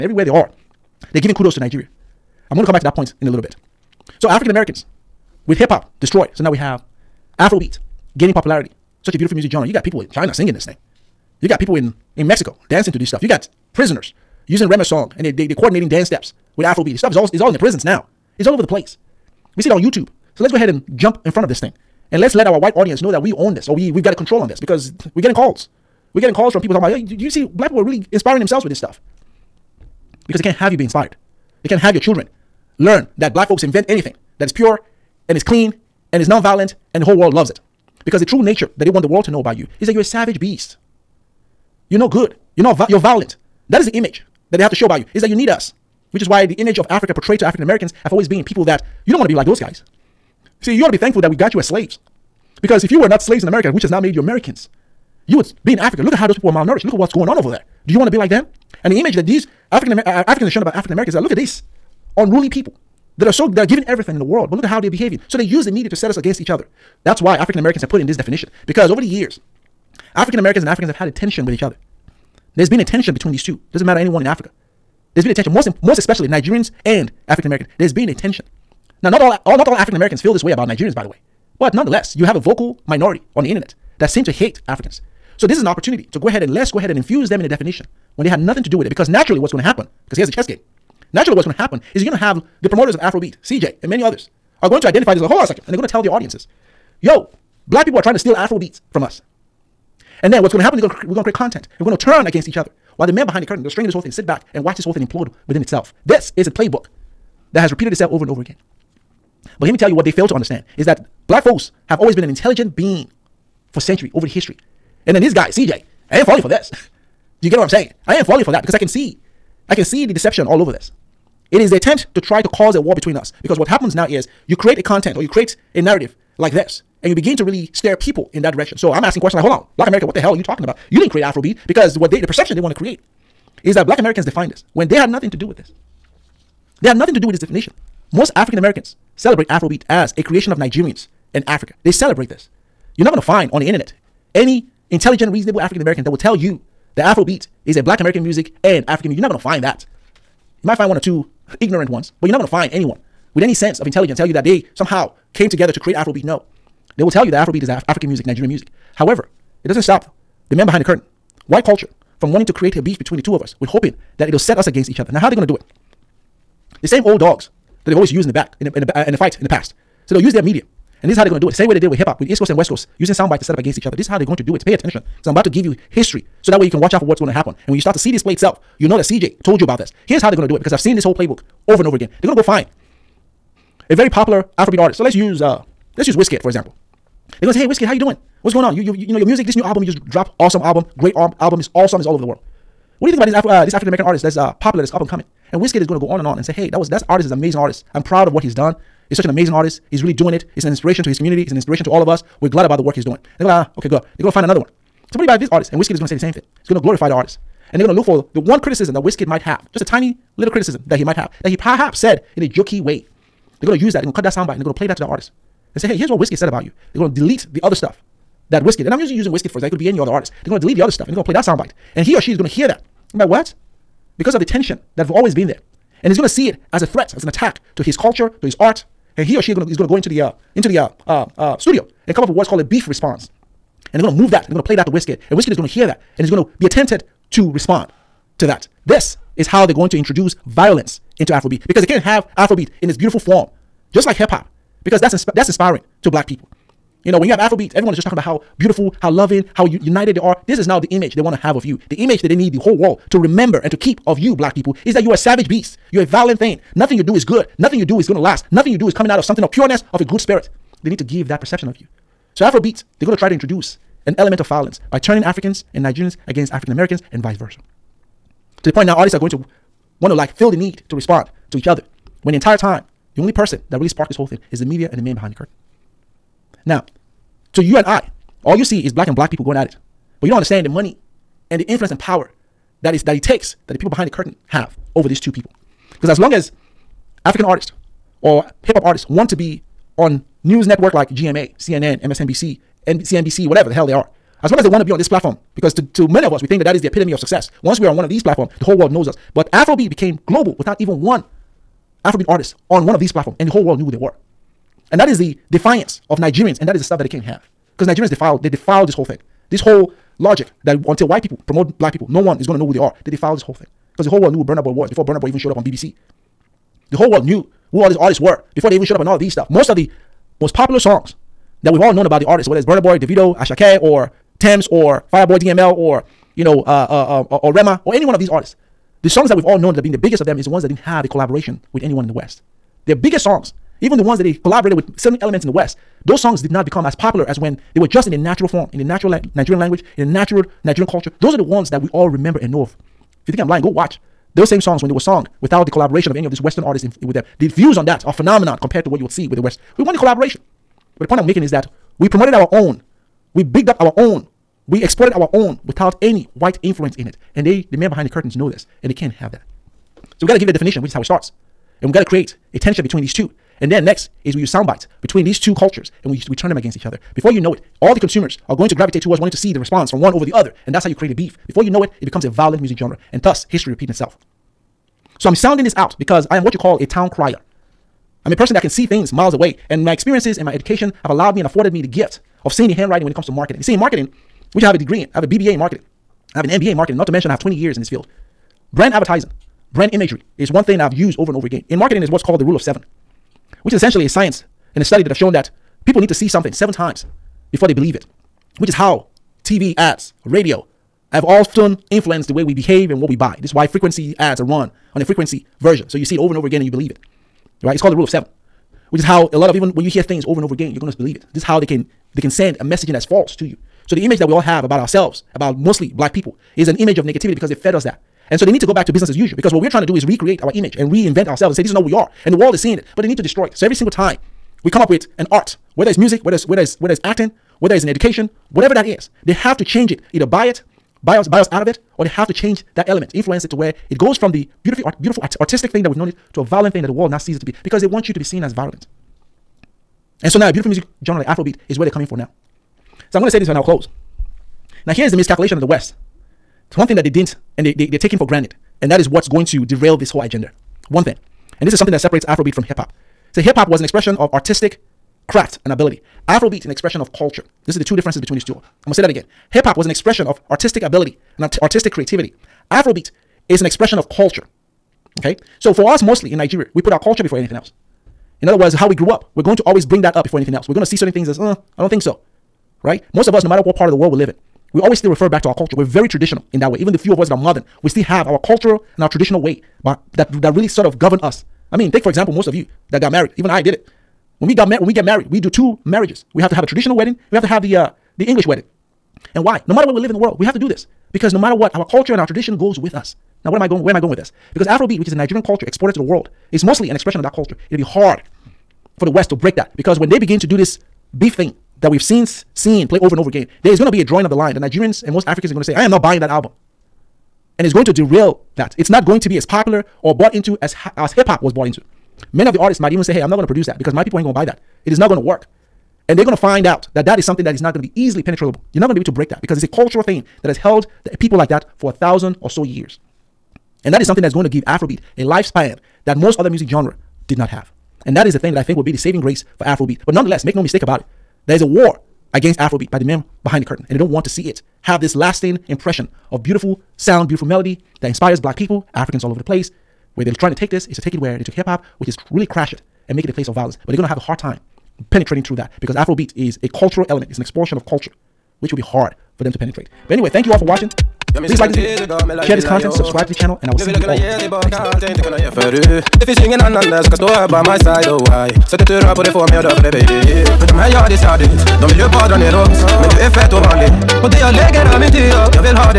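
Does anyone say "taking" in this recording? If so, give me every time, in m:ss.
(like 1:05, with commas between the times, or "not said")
7:28.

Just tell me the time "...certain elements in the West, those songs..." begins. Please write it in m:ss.
5:34.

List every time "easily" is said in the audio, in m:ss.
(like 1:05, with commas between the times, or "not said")
8:37.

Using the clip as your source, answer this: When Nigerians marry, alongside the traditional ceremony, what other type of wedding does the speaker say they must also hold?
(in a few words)
English wedding.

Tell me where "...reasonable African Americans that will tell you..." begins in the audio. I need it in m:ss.
2:25.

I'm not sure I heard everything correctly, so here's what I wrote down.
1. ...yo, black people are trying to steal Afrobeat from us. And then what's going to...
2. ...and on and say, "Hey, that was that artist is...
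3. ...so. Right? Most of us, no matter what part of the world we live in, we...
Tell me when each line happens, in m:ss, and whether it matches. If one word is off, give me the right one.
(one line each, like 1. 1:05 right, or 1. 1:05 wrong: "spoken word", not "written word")
1. 1:37 right
2. 3:16 right
3. 7:52 right.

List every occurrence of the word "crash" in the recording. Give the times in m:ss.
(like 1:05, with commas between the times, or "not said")
9:02.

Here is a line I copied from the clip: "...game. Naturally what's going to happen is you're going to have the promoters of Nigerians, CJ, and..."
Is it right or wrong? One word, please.
wrong.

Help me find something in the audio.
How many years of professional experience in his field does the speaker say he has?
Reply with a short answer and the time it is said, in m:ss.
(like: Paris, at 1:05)
20 years, at 6:27.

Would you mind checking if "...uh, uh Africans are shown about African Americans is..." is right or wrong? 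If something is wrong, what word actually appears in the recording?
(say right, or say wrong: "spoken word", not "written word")
right.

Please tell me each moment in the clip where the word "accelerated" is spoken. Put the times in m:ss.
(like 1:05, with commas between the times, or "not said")
not said.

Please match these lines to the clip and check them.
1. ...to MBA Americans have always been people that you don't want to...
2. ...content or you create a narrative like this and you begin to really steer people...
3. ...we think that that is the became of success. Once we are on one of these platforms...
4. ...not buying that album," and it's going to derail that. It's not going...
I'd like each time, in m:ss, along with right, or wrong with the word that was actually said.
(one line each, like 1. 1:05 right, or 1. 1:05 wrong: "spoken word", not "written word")
1. 0:47 wrong: "African", not "MBA"
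2. 2:04 right
3. 4:56 wrong: "epitome", not "became"
4. 8:25 right.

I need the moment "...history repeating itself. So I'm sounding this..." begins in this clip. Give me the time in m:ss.
6:13.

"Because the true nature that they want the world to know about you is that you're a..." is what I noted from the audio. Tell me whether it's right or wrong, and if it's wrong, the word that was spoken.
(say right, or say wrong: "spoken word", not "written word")
right.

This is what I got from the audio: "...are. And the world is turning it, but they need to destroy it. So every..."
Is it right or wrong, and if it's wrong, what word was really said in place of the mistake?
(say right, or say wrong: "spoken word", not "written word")
wrong: "seeing", not "turning".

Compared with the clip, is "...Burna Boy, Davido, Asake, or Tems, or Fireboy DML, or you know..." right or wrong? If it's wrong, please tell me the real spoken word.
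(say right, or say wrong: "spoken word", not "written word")
right.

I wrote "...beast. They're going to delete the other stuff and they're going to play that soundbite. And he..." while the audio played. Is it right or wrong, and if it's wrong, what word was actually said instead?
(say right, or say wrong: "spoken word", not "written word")
wrong: "artist", not "beast".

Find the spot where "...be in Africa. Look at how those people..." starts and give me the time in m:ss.
0:55.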